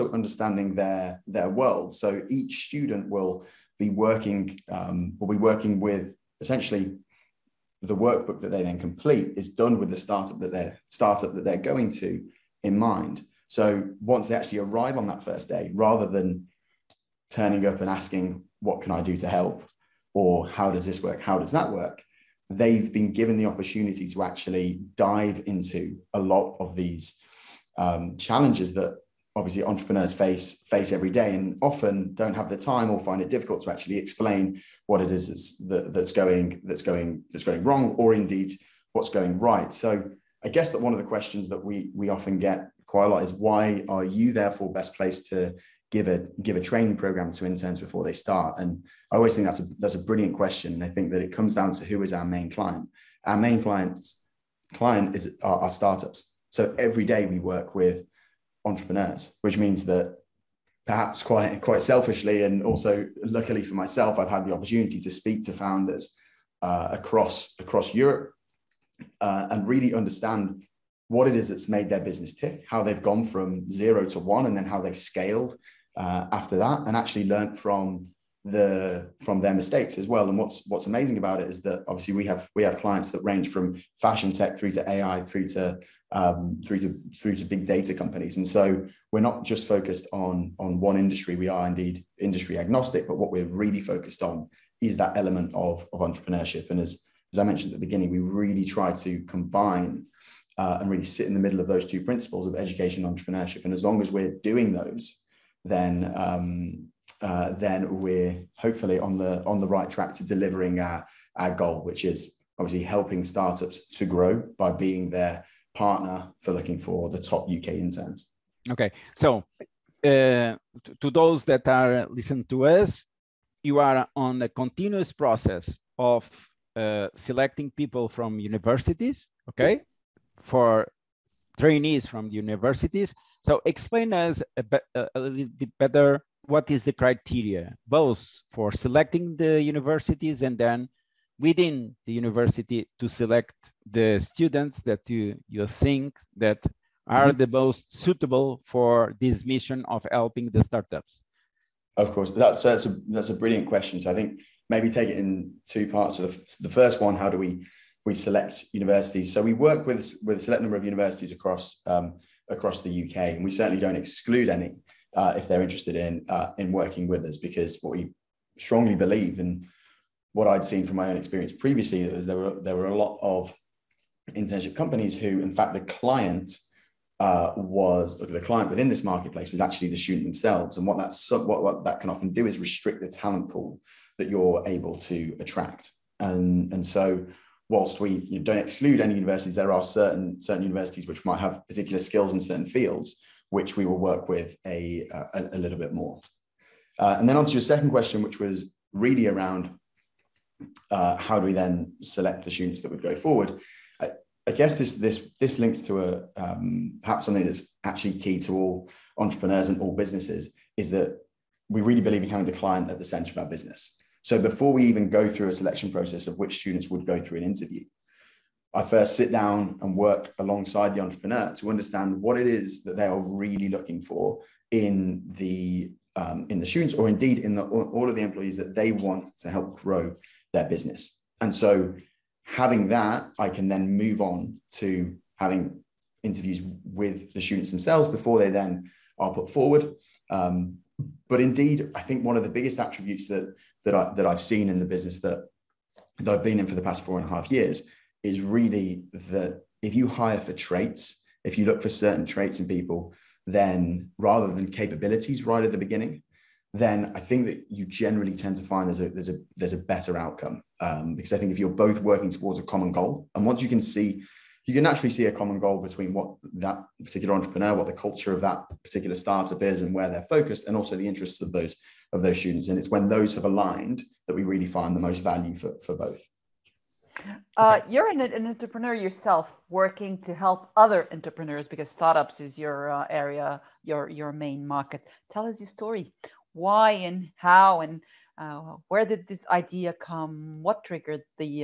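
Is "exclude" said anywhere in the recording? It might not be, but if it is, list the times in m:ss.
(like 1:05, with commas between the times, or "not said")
2:44, 3:08.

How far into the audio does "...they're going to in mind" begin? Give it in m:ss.
0:11.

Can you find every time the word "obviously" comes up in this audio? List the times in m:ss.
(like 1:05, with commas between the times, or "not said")
0:29, 1:21, 1:52.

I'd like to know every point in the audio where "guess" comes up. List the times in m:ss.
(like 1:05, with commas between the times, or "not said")
0:40, 3:24.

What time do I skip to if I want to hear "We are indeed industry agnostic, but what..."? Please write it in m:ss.
1:31.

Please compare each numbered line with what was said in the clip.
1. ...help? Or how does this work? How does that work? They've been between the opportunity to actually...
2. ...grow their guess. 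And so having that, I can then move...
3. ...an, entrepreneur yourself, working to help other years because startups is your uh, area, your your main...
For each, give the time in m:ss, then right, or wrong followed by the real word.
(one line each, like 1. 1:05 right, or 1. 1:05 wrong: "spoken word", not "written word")
1. 0:19 wrong: "given", not "between"
2. 3:49 wrong: "business", not "guess"
3. 4:38 wrong: "entrepreneurs", not "years".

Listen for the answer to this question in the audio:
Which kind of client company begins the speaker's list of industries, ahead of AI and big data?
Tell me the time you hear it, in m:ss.
1:24.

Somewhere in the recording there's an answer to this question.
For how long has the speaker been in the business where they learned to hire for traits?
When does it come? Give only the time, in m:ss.
4:07.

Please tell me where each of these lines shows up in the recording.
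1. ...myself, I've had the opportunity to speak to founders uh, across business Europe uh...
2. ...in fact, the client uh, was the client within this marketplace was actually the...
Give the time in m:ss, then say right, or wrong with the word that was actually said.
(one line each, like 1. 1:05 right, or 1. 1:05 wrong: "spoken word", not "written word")
1. 1:03 wrong: "across", not "business"
2. 2:55 right.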